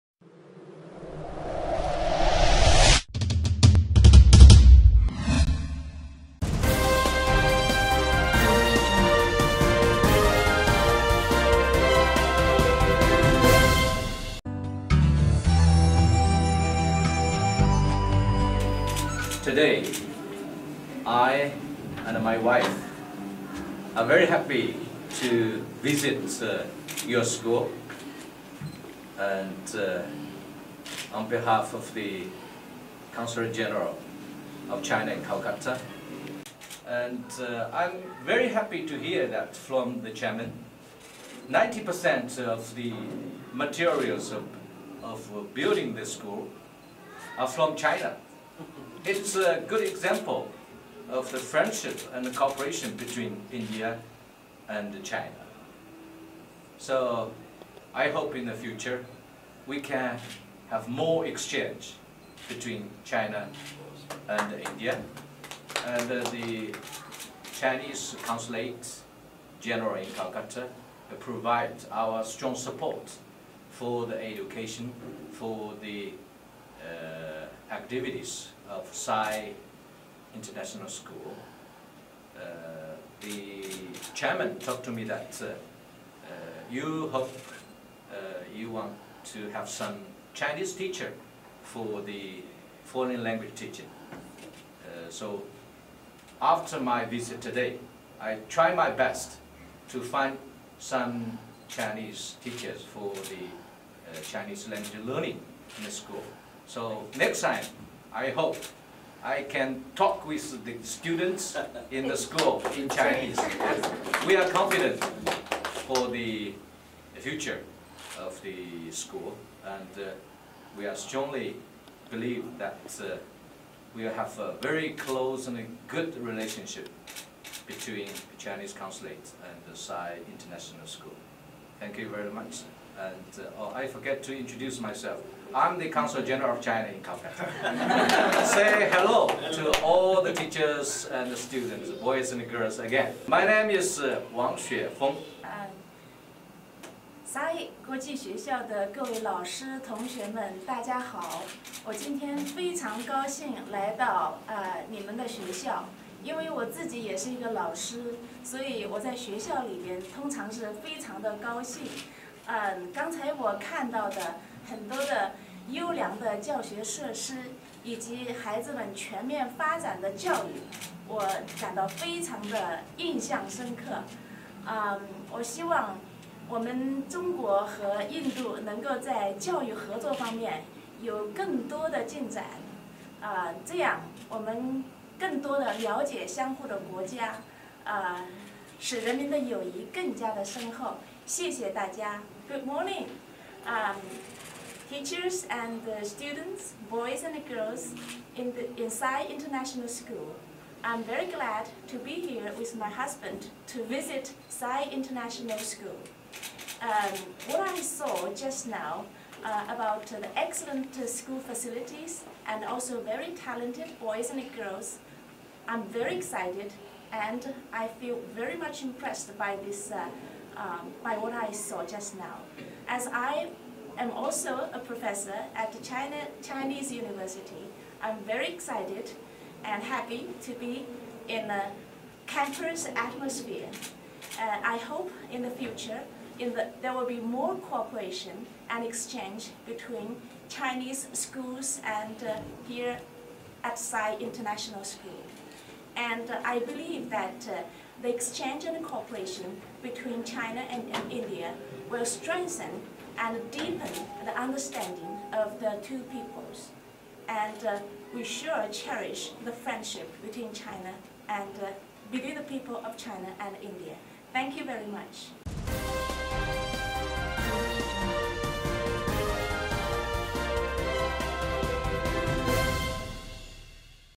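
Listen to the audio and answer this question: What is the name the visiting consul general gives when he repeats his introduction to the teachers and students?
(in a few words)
Wang Xuefeng.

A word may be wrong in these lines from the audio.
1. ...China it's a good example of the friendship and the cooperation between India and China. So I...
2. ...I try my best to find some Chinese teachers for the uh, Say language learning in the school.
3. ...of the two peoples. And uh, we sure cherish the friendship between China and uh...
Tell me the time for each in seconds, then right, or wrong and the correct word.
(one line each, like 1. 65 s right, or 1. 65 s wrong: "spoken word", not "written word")
1. 47 s right
2. 98 s wrong: "Chinese", not "Say"
3. 255 s right.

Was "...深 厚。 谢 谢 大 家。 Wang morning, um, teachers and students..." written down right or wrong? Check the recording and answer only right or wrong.
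wrong.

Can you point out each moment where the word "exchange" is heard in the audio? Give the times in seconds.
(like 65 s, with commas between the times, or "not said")
61 s, 238 s, 248 s.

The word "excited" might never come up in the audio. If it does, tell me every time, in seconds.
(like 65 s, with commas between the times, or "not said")
216 s, 228 s.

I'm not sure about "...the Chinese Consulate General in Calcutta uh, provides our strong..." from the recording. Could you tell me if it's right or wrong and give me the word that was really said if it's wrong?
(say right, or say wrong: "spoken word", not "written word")
right.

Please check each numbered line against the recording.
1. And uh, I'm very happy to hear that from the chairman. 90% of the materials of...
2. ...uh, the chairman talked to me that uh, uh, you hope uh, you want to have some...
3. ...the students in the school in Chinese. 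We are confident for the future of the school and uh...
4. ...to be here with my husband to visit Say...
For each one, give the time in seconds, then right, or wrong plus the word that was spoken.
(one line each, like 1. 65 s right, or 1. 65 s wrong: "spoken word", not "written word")
1. 36 s right
2. 82 s right
3. 110 s right
4. 201 s wrong: "Sai", not "Say".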